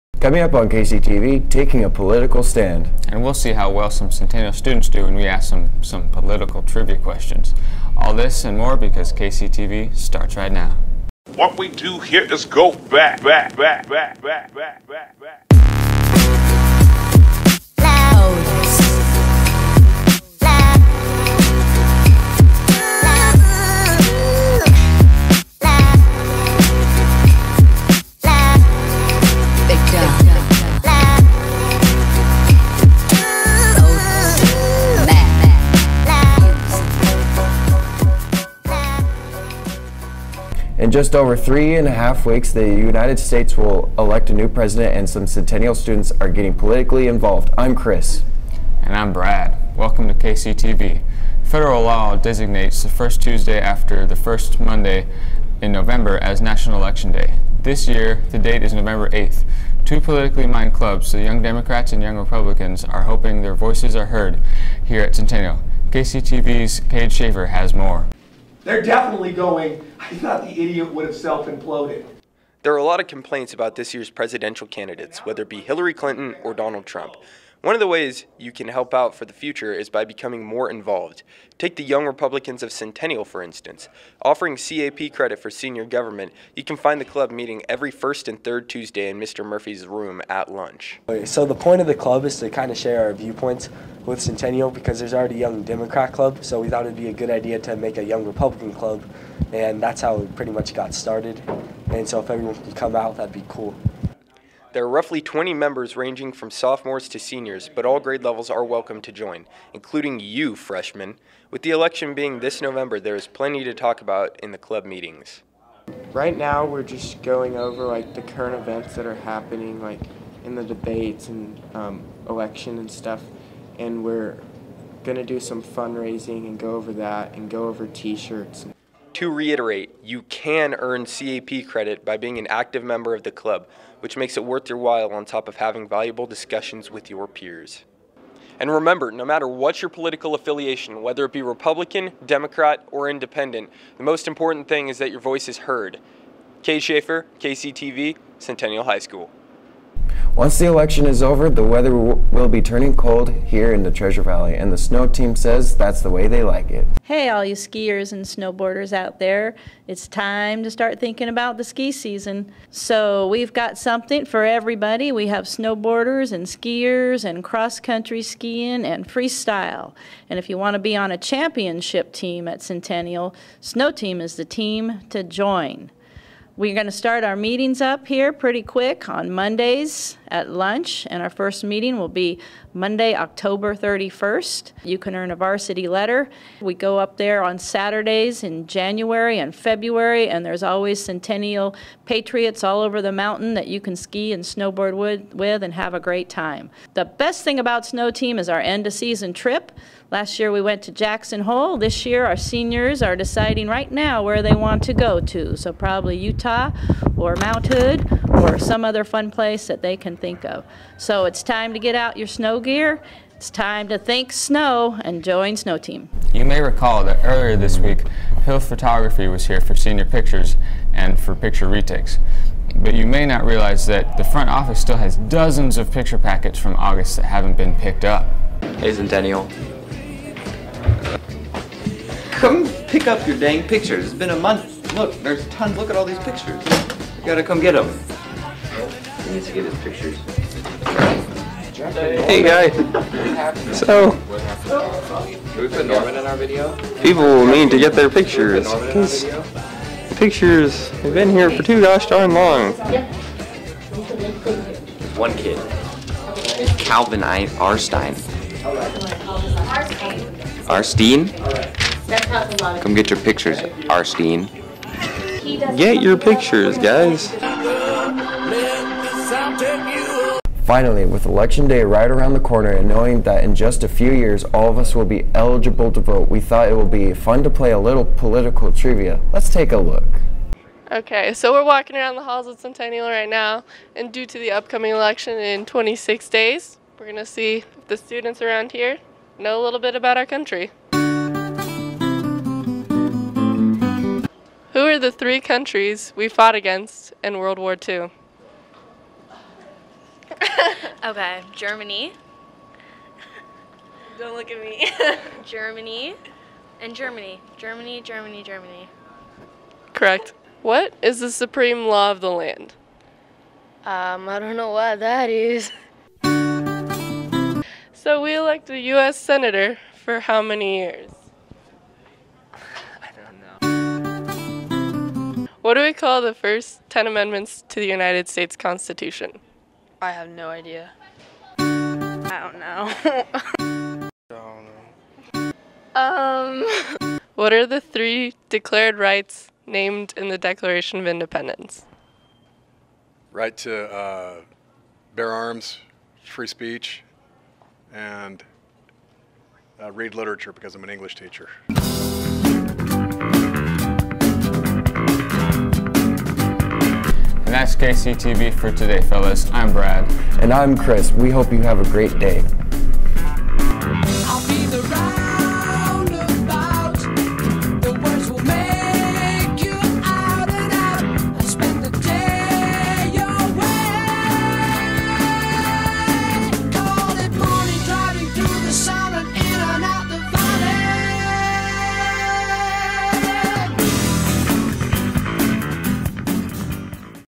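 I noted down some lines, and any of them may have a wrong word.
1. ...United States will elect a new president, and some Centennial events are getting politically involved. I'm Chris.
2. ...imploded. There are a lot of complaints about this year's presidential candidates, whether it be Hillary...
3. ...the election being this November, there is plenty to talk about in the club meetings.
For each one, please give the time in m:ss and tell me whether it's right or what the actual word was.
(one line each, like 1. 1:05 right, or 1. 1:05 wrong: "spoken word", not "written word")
1. 0:42 wrong: "students", not "events"
2. 1:11 right
3. 1:51 right.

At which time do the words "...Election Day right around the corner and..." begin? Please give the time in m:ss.
4:31.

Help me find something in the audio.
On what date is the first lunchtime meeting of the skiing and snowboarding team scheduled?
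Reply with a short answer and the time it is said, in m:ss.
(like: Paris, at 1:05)
Monday, October 31st, at 3:02.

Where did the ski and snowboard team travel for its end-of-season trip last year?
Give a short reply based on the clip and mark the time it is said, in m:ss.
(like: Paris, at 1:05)
Jackson Hole, at 3:20.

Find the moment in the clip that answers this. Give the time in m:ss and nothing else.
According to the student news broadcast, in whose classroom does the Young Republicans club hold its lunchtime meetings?
1:29.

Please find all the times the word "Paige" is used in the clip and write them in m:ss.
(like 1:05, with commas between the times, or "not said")
1:06.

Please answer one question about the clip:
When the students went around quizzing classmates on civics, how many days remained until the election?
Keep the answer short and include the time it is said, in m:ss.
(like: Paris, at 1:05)
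26, at 4:45.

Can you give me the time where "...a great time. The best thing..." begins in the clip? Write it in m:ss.
3:15.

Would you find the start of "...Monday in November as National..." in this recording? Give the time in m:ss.
0:54.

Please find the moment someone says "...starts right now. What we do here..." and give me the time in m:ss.
0:09.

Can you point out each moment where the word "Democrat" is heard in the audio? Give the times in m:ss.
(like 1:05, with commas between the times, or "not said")
1:01, 1:35, 2:22.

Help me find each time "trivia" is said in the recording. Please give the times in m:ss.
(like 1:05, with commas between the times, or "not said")
0:06, 4:38.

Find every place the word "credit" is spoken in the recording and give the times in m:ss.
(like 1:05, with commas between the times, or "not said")
1:25, 2:11.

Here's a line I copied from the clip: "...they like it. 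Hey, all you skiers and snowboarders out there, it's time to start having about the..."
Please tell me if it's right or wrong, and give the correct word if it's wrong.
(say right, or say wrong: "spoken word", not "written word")
wrong: "thinking", not "having".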